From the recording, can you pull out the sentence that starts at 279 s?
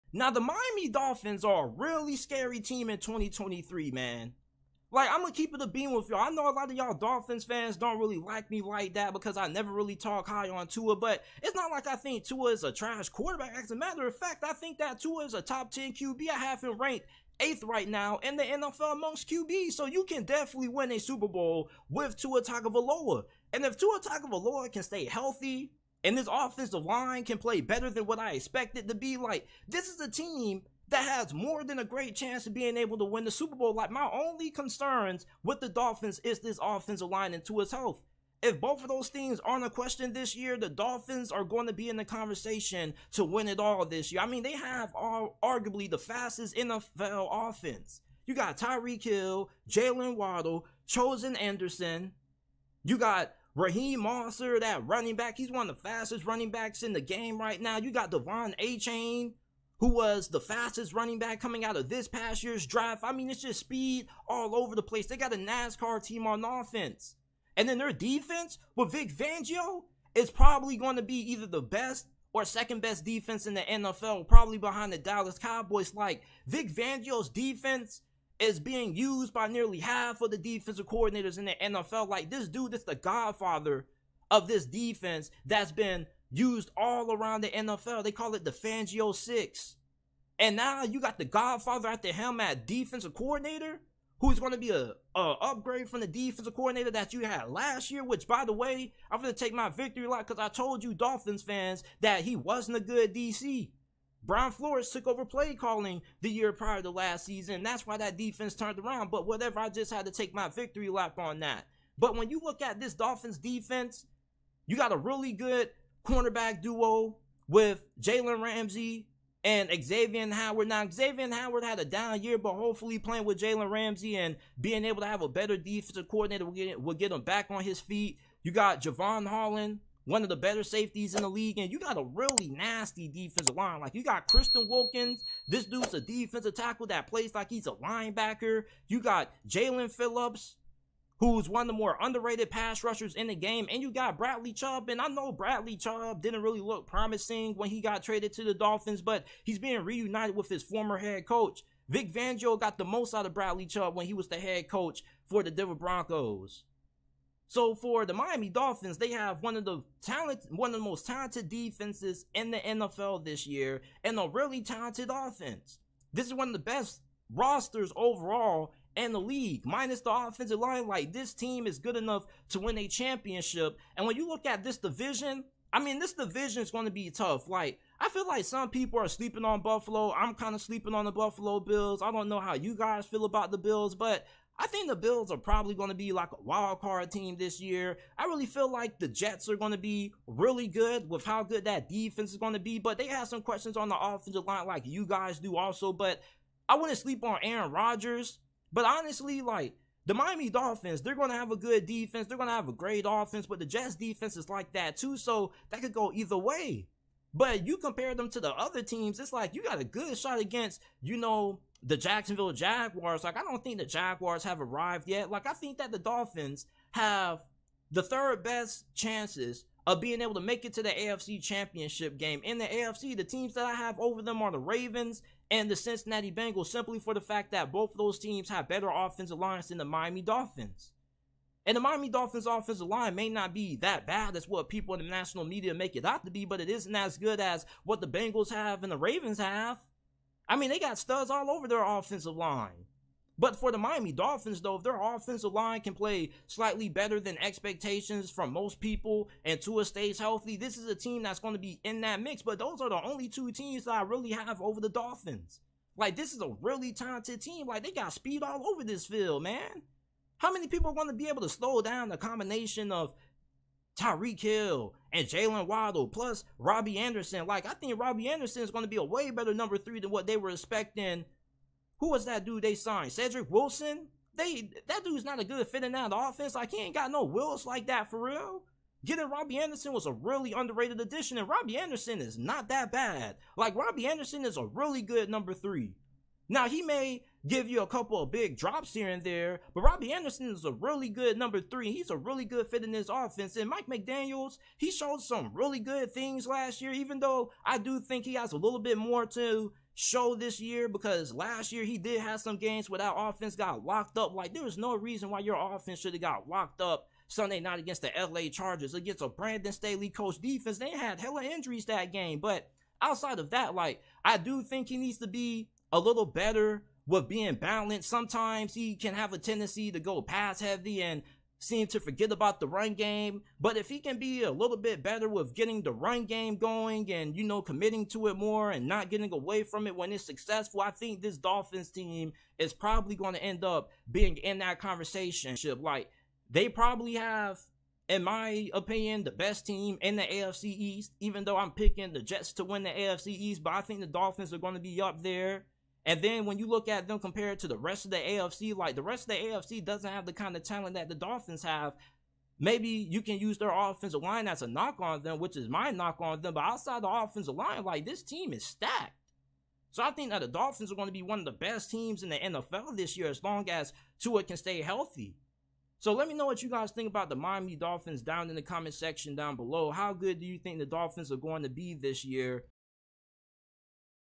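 Getting Robbie Anderson was a really underrated addition, and Robbie Anderson is not that bad.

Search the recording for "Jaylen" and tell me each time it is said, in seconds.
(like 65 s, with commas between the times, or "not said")
49 s, 265 s.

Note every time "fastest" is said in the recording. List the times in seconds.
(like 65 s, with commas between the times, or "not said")
45 s, 55 s, 60 s.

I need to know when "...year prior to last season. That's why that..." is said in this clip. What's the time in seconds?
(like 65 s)
106 s.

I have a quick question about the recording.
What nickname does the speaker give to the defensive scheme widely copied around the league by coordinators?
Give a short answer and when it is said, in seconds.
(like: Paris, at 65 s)
Fangio Six, at 88 s.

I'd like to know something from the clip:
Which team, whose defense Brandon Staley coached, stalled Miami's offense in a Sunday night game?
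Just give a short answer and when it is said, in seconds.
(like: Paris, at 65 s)
LA Chargers, at 308 s.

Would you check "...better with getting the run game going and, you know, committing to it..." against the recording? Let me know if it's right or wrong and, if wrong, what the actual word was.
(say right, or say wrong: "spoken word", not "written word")
right.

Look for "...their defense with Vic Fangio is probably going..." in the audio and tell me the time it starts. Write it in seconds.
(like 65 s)
67 s.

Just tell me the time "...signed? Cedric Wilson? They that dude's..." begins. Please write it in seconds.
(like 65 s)
272 s.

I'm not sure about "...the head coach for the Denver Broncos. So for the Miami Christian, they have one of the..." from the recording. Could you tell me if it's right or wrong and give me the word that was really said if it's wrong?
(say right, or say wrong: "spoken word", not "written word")
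wrong: "Dolphins", not "Christian".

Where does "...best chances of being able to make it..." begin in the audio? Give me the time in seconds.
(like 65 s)
218 s.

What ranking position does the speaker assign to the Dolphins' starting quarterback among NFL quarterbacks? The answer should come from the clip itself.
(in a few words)
8th.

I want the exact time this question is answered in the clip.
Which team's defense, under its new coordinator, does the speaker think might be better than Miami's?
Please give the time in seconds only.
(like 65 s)
74 s.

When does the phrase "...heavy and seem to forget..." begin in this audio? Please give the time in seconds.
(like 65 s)
320 s.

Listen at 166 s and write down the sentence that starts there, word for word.
This is one of the best rosters overall in the league, minus the offensive line.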